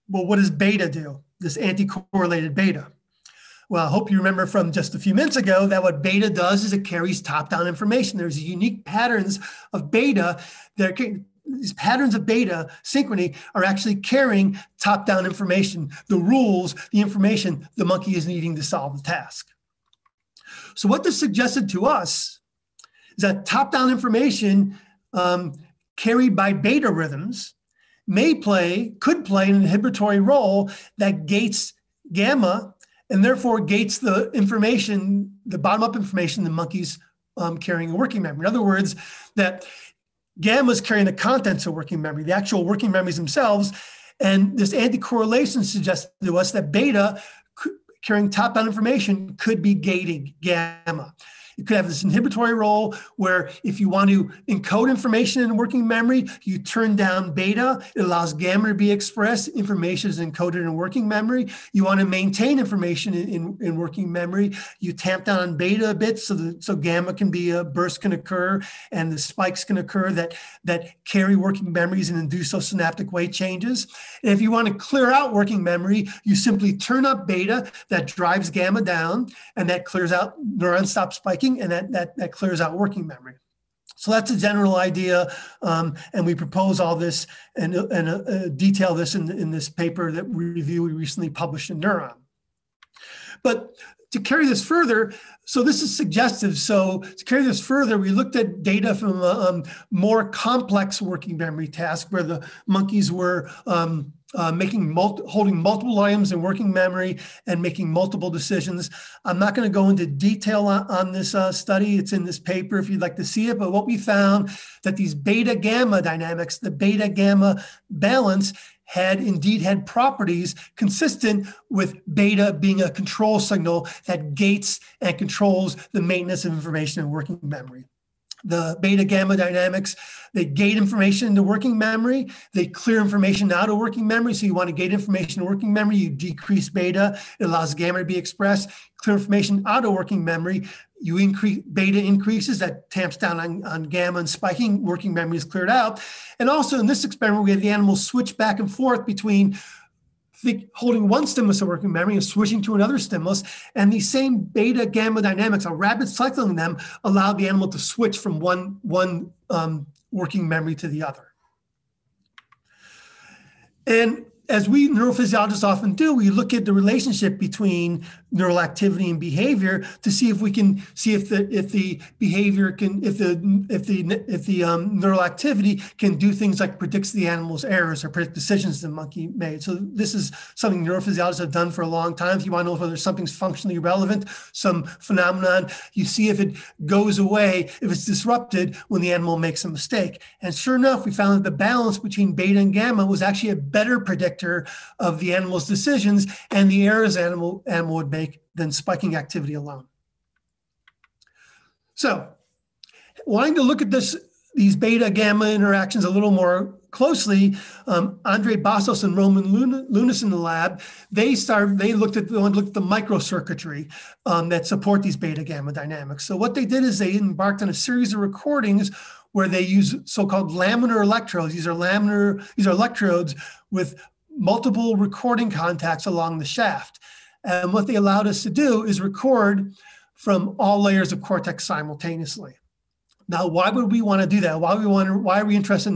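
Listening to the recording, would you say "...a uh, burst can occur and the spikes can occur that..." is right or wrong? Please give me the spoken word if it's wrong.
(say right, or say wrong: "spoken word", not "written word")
right.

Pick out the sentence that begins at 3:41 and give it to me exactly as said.
These are laminar, these are electrodes with multiple recording contacts along the shaft.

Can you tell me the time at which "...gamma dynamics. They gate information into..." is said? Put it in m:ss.
2:09.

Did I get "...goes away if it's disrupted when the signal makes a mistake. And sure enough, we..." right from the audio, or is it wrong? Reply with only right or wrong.
wrong.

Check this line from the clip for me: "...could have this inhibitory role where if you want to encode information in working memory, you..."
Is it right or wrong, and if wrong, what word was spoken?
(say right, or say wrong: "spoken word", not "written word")
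right.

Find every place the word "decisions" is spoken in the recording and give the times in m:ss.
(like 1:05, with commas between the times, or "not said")
1:48, 2:58, 3:15.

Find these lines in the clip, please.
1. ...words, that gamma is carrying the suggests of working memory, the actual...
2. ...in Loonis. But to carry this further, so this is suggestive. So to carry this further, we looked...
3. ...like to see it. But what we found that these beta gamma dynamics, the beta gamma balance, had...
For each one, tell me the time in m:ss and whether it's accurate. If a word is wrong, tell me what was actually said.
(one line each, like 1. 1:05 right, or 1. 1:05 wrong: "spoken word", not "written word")
1. 0:38 wrong: "contents", not "suggests"
2. 1:31 wrong: "Neuron", not "Loonis"
3. 1:53 right.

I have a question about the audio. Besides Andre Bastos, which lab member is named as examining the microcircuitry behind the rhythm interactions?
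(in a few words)
Roman Loonis.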